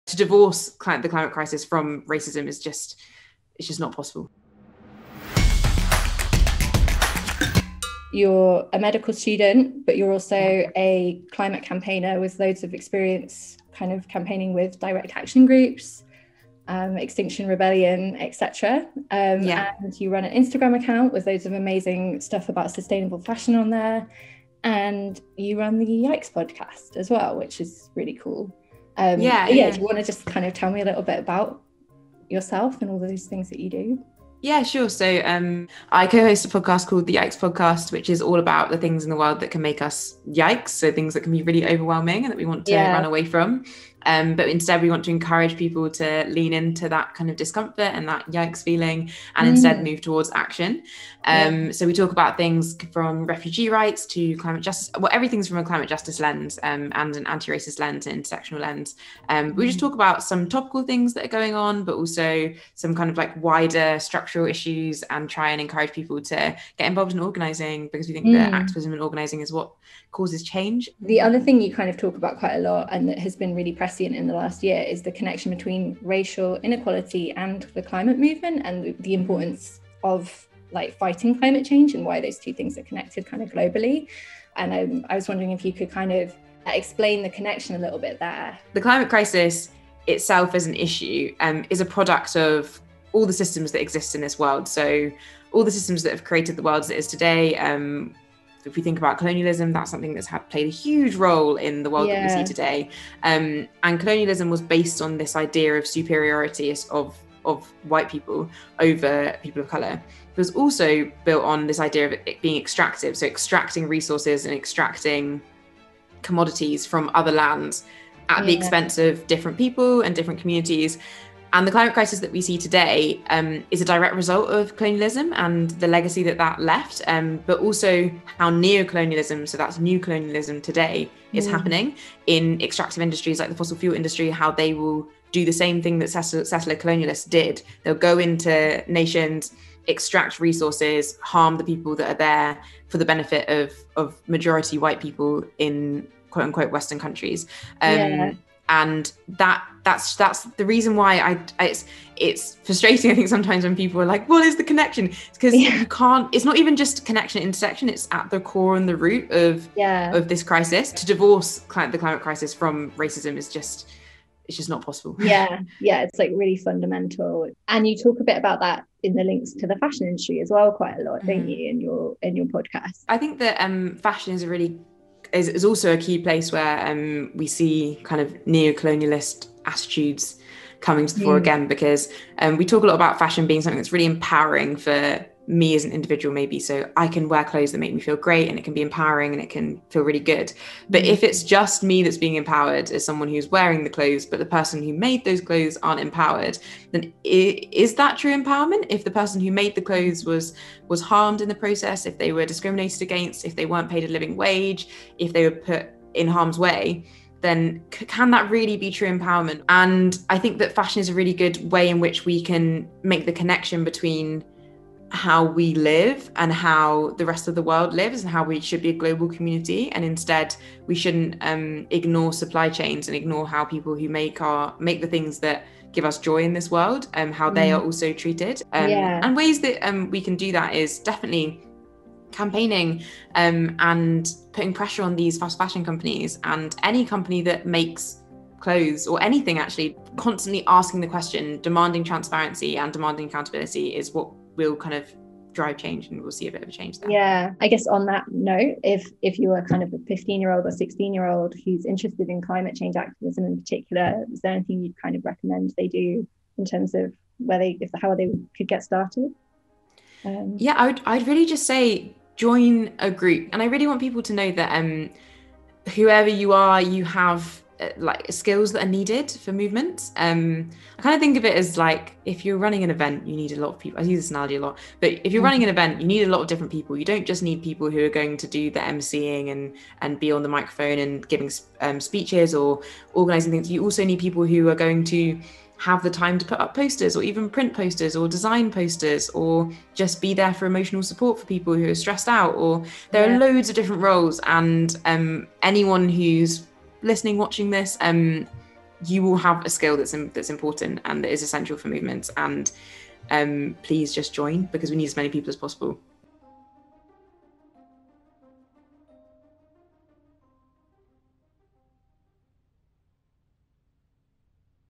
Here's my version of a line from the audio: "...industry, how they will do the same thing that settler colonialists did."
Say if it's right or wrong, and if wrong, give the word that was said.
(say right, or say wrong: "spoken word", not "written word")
right.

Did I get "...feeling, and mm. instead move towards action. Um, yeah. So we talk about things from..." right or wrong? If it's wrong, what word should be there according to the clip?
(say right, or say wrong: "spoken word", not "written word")
right.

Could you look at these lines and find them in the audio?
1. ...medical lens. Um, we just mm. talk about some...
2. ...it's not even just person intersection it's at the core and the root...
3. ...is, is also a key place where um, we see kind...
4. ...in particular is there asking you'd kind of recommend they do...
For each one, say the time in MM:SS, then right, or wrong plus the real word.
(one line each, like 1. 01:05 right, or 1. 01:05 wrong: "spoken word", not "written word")
1. 00:58 wrong: "intersectional", not "medical"
2. 02:36 wrong: "connection", not "person"
3. 02:55 right
4. 04:13 wrong: "anything", not "asking".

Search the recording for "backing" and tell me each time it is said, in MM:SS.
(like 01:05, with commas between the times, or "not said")
not said.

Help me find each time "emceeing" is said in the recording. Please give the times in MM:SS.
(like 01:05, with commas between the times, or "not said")
04:38.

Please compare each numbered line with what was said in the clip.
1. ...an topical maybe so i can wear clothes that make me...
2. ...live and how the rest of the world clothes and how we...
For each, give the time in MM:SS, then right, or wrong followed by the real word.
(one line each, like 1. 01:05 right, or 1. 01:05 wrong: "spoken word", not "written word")
1. 03:05 wrong: "individual", not "topical"
2. 03:35 wrong: "lives", not "clothes".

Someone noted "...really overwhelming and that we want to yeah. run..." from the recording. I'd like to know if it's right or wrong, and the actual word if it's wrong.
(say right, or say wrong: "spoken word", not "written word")
right.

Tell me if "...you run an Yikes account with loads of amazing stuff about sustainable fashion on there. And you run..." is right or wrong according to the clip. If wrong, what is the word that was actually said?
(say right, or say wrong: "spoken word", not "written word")
wrong: "Instagram", not "Yikes".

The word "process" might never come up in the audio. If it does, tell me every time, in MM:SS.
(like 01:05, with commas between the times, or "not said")
03:21.